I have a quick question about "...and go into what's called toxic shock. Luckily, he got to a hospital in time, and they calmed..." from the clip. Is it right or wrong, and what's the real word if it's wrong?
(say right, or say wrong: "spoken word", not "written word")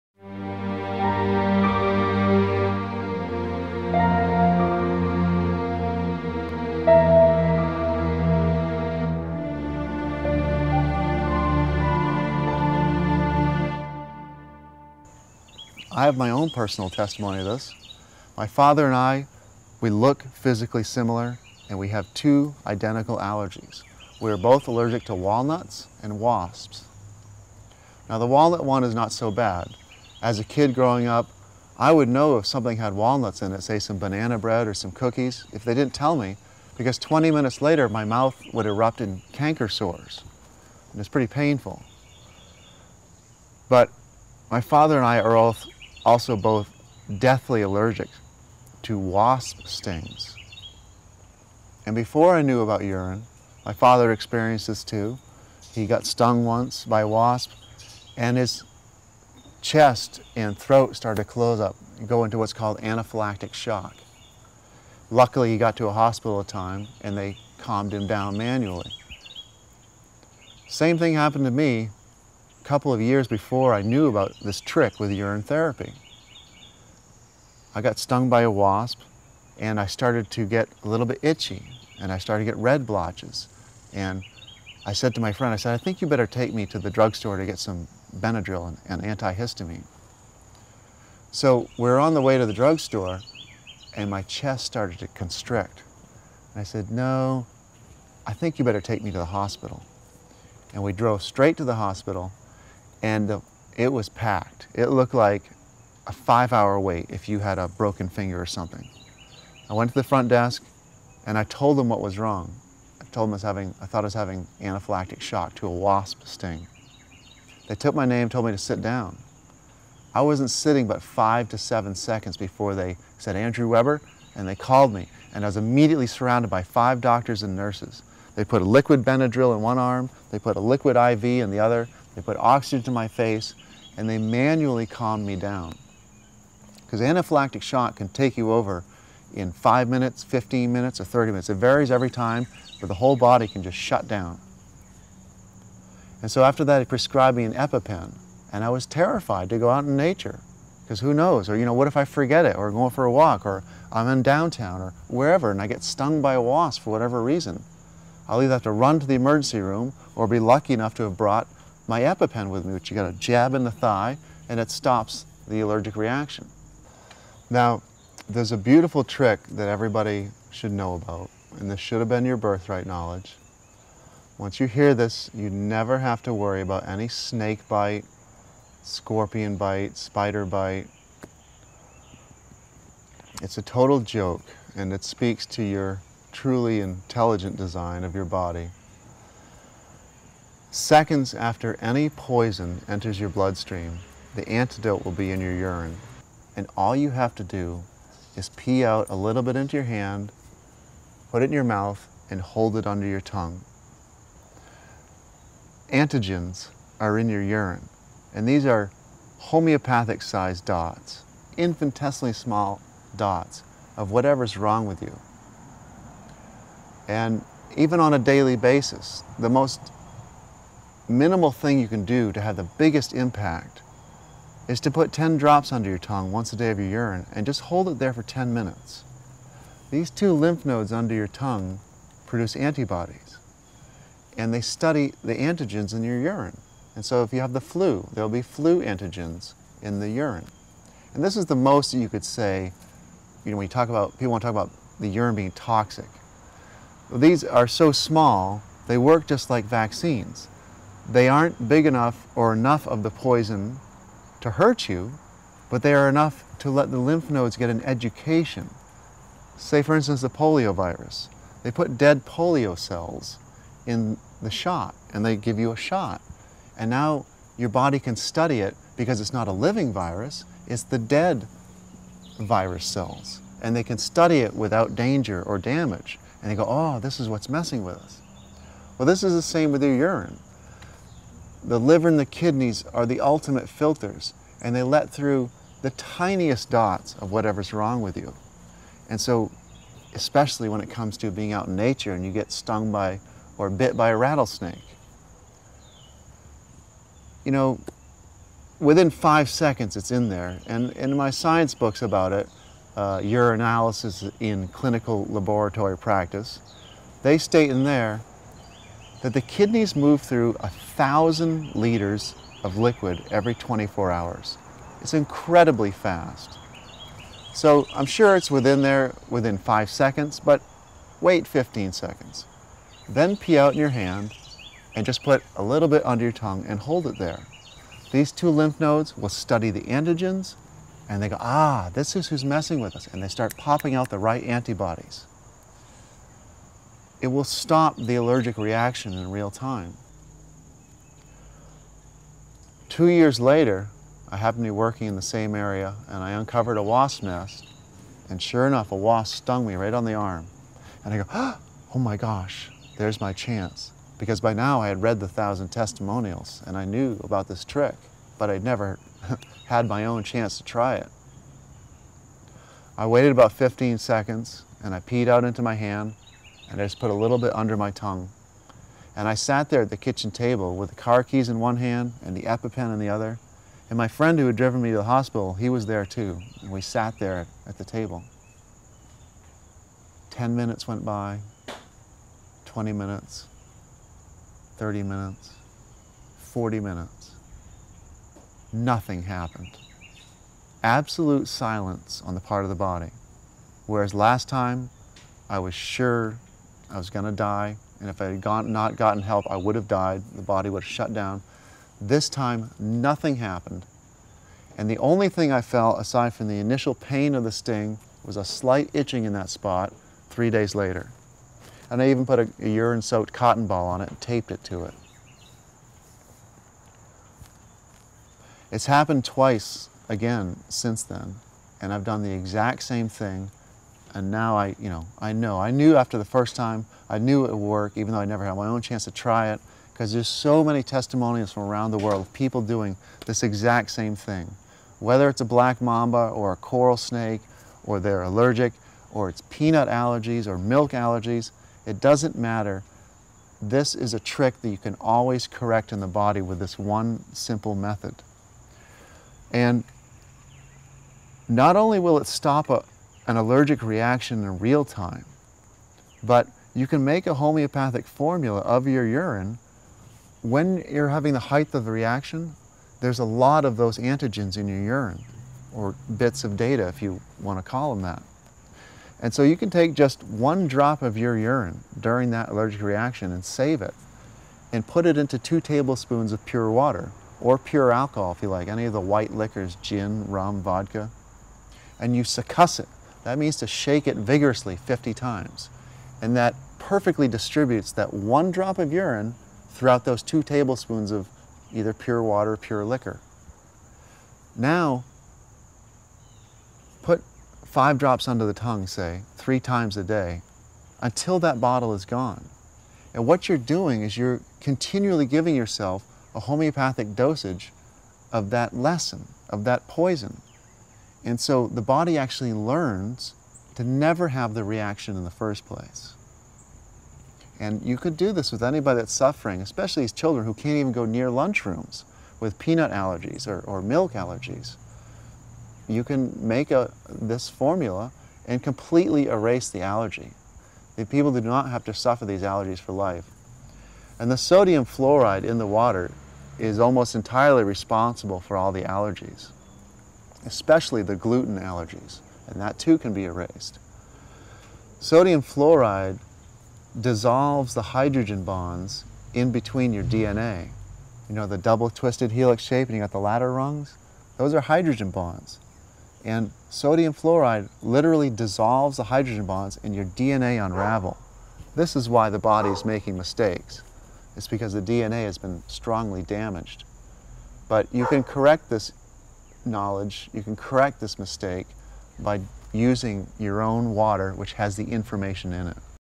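wrong: "anaphylactic", not "toxic".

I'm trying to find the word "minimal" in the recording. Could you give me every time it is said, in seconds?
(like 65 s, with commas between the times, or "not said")
221 s.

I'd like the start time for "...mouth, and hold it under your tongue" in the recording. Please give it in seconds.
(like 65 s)
201 s.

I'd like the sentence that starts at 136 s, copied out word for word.
Because anaphylactic shock can take you over in five minutes, 15 minutes, or 30 minutes.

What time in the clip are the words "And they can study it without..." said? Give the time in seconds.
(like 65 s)
273 s.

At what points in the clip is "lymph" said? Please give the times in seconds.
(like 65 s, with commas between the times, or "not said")
230 s, 256 s, 328 s.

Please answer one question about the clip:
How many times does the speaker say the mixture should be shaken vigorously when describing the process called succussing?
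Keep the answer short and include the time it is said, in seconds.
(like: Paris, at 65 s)
50, at 484 s.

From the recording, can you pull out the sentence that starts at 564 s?
It's because the DNA has been strongly damaged.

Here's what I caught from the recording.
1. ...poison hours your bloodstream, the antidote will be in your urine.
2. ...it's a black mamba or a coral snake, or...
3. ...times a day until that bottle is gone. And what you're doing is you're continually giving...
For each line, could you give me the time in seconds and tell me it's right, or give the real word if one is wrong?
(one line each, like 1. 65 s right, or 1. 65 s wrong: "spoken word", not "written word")
1. 192 s wrong: "enters", not "hours"
2. 435 s right
3. 499 s right.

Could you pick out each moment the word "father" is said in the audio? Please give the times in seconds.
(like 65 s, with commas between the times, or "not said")
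18 s, 44 s, 53 s.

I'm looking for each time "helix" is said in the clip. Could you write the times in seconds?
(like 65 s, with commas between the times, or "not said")
552 s.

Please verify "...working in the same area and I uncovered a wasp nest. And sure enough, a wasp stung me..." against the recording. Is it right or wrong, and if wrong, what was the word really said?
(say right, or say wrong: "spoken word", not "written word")
right.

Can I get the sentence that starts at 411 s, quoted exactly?
And I even put a, a urine soaked cotton ball on it and taped it to it.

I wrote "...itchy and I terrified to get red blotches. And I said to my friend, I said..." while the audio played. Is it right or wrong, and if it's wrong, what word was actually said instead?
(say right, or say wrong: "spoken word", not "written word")
wrong: "started", not "terrified".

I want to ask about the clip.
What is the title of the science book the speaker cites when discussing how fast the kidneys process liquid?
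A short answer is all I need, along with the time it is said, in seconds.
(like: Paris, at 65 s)
Urinalysis in Clinical Laboratory Practice, at 303 s.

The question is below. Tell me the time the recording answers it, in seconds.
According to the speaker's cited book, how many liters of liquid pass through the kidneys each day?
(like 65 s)
310 s.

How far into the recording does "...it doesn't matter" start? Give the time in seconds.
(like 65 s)
441 s.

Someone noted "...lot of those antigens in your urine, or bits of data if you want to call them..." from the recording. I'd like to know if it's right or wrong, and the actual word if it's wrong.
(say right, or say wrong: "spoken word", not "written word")
right.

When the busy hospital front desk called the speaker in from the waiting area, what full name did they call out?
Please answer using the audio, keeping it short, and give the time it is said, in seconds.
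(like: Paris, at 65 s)
Andrew Webber, at 123 s.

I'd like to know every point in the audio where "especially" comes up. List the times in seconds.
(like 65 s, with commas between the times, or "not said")
290 s, 519 s, 540 s.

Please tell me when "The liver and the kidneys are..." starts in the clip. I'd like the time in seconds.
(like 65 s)
281 s.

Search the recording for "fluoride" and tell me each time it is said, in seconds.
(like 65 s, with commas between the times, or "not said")
534 s, 545 s, 557 s.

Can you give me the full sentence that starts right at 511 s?
And so the body actually learns to never have the reaction in the first place.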